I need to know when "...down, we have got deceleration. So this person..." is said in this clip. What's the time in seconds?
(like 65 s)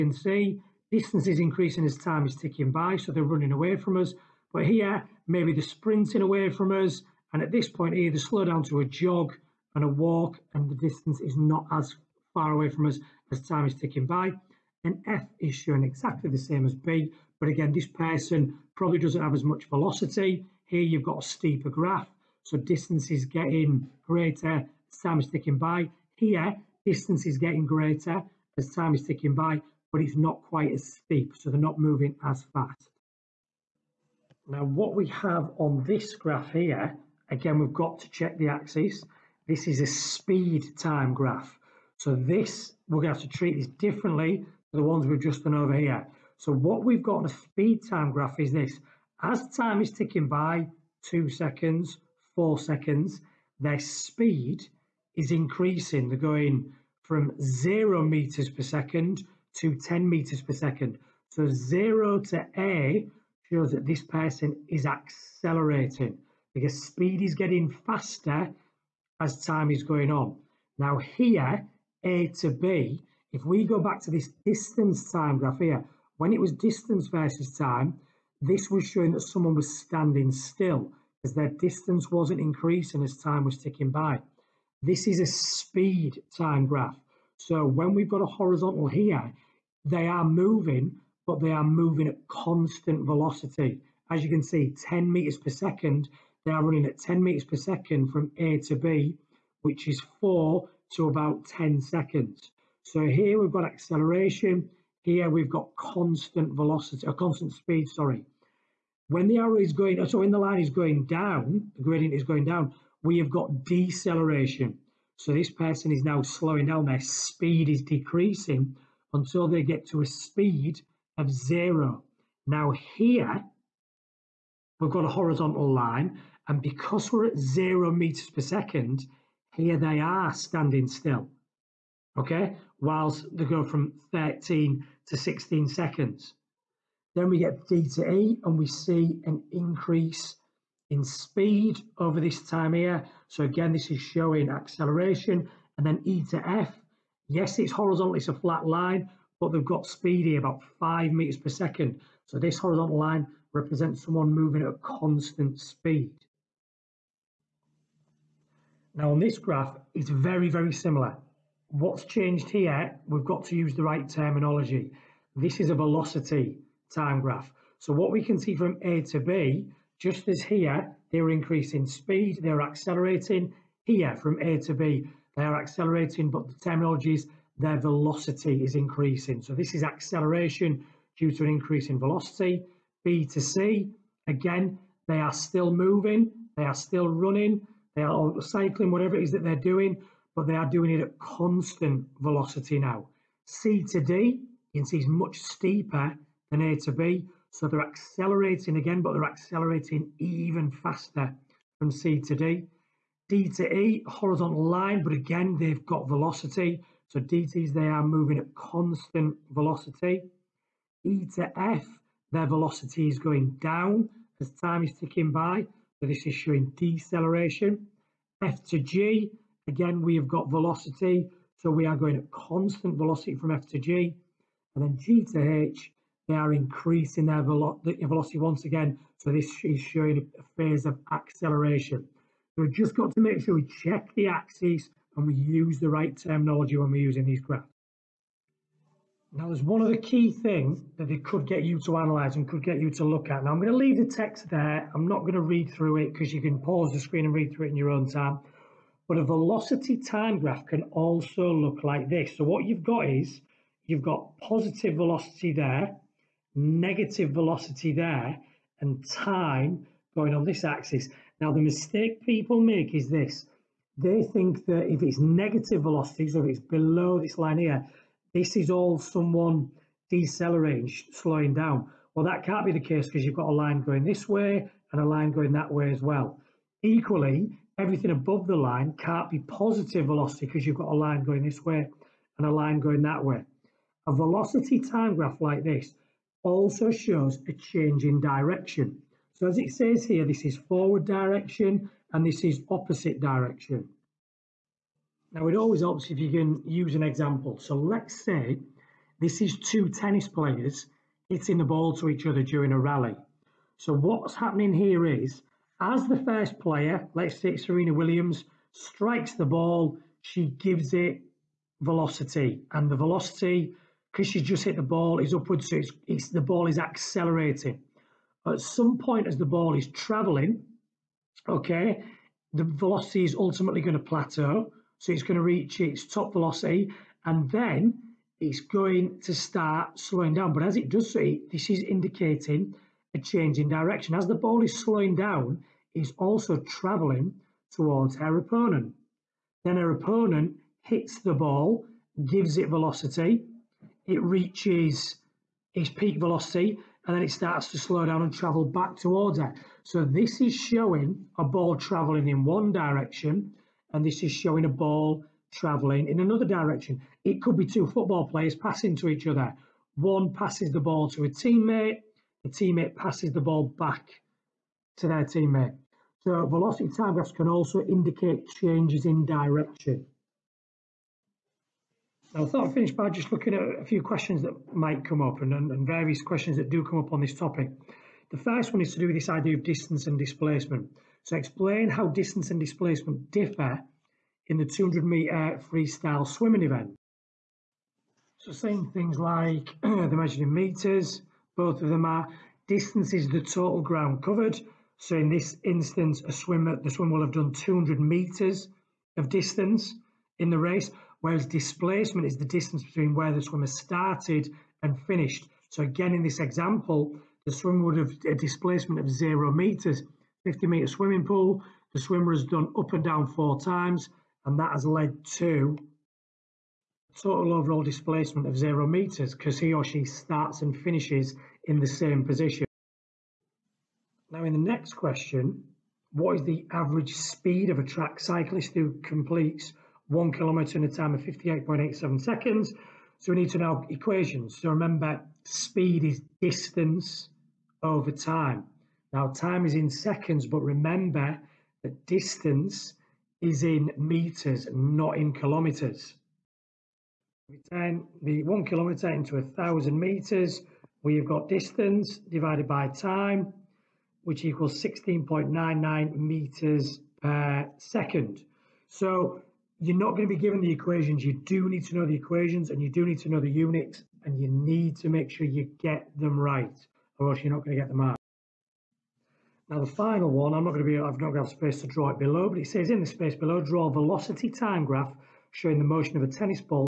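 112 s.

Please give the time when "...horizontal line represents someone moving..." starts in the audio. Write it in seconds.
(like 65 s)
152 s.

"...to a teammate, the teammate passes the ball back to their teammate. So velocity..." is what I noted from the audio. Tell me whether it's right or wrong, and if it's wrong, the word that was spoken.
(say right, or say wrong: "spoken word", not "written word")
right.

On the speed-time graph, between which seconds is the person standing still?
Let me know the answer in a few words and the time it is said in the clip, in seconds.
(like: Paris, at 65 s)
13 to 16 seconds, at 134 s.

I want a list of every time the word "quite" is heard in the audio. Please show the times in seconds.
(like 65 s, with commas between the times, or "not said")
30 s.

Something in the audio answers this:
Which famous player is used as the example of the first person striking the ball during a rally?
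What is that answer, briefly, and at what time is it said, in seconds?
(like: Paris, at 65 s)
Serena Williams, at 307 s.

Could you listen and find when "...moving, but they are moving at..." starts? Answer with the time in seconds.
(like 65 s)
90 s.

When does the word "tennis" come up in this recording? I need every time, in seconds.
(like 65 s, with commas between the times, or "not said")
299 s, 476 s.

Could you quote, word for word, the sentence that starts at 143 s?
So again, this is showing acceleration.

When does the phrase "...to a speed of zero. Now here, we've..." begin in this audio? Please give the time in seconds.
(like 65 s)
119 s.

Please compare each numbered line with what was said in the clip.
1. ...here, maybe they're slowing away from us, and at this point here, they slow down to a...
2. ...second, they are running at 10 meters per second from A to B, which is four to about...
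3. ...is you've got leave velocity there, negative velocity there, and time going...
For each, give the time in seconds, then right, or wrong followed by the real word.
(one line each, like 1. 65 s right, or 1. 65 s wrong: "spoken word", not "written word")
1. 4 s wrong: "sprinting", not "slowing"
2. 95 s right
3. 253 s wrong: "positive", not "leave".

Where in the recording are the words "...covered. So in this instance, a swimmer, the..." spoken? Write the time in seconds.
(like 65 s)
394 s.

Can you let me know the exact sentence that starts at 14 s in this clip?
And F is showing exactly the same as B, but again, this person probably doesn't have as much velocity.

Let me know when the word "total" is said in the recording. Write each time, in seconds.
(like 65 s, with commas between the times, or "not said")
393 s, 417 s.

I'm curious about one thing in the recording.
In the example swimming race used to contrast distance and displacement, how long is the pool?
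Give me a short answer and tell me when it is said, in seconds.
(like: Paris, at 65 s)
50 meters, at 410 s.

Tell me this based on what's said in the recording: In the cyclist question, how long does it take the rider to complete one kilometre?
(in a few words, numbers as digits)
58.87 seconds.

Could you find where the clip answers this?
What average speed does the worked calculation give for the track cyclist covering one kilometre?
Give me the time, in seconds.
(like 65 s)
454 s.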